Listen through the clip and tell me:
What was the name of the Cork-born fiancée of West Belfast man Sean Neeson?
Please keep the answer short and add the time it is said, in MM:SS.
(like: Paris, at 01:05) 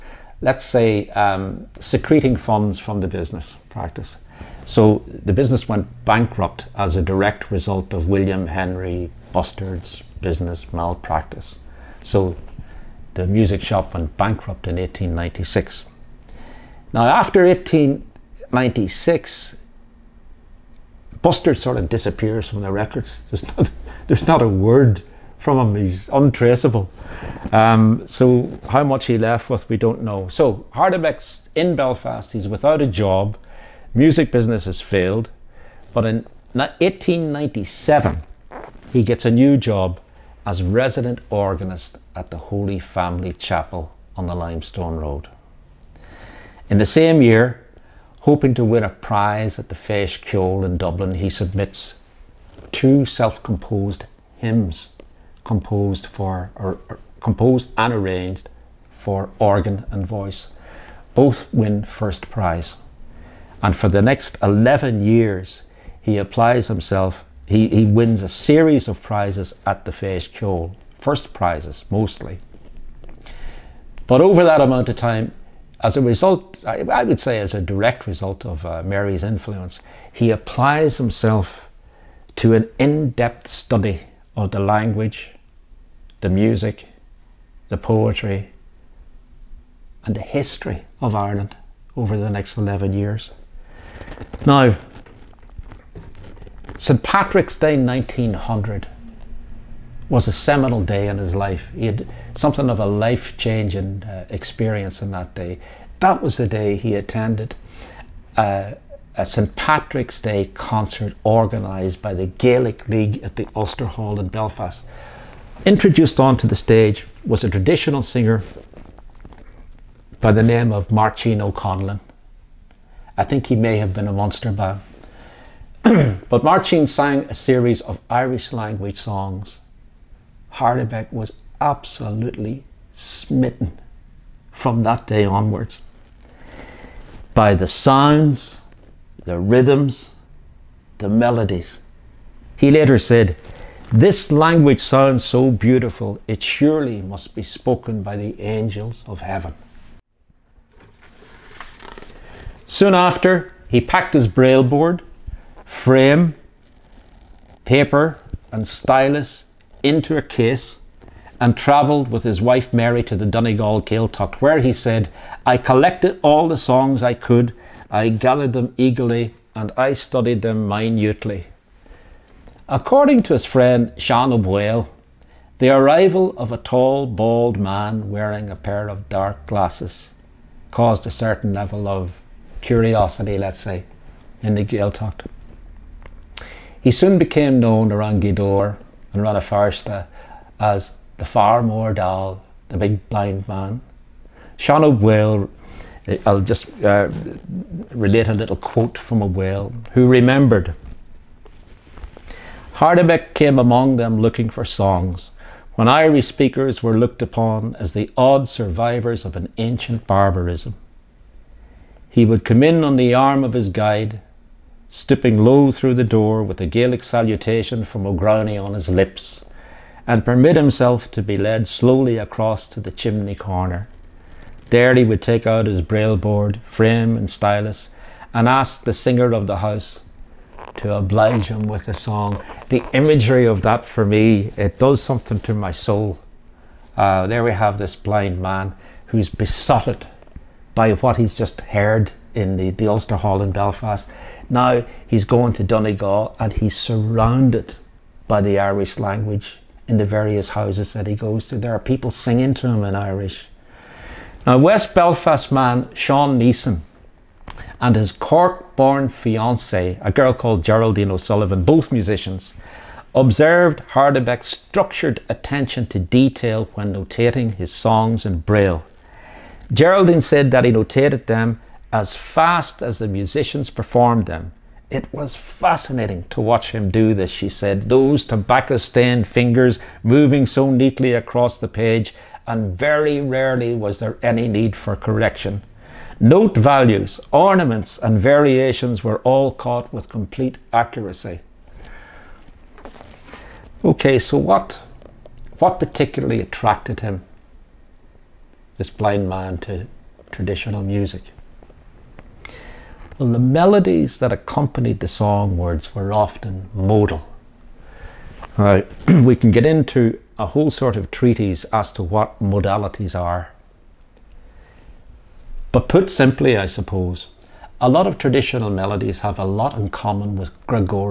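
Geraldine O'Sullivan, at 04:20.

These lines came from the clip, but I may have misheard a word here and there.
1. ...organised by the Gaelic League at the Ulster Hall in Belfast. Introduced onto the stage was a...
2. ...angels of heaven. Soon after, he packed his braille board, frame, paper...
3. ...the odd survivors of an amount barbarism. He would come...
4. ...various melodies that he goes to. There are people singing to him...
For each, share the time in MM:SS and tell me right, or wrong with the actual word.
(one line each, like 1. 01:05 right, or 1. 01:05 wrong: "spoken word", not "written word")
1. 01:51 right
2. 02:28 right
3. 03:27 wrong: "ancient", not "amount"
4. 04:10 wrong: "houses", not "melodies".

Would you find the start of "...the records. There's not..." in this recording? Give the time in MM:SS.
00:22.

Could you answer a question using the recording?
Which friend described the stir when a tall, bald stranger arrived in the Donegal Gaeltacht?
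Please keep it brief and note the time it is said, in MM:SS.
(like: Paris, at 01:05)
Sean O'Boyle, at 02:53.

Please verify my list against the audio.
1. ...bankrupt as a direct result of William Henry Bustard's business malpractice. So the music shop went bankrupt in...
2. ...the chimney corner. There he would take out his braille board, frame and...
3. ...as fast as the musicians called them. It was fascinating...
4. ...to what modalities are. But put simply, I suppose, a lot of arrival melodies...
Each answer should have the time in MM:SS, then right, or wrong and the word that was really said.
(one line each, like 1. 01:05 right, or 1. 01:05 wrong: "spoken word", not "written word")
1. 00:06 right
2. 03:42 right
3. 04:31 wrong: "performed", not "called"
4. 05:11 wrong: "traditional", not "arrival".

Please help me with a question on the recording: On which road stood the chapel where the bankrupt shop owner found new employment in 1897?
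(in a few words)
Limestone Road.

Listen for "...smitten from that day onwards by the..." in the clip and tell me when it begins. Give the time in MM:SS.
02:12.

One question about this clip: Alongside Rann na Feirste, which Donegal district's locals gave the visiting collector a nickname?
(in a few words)
Gweedore.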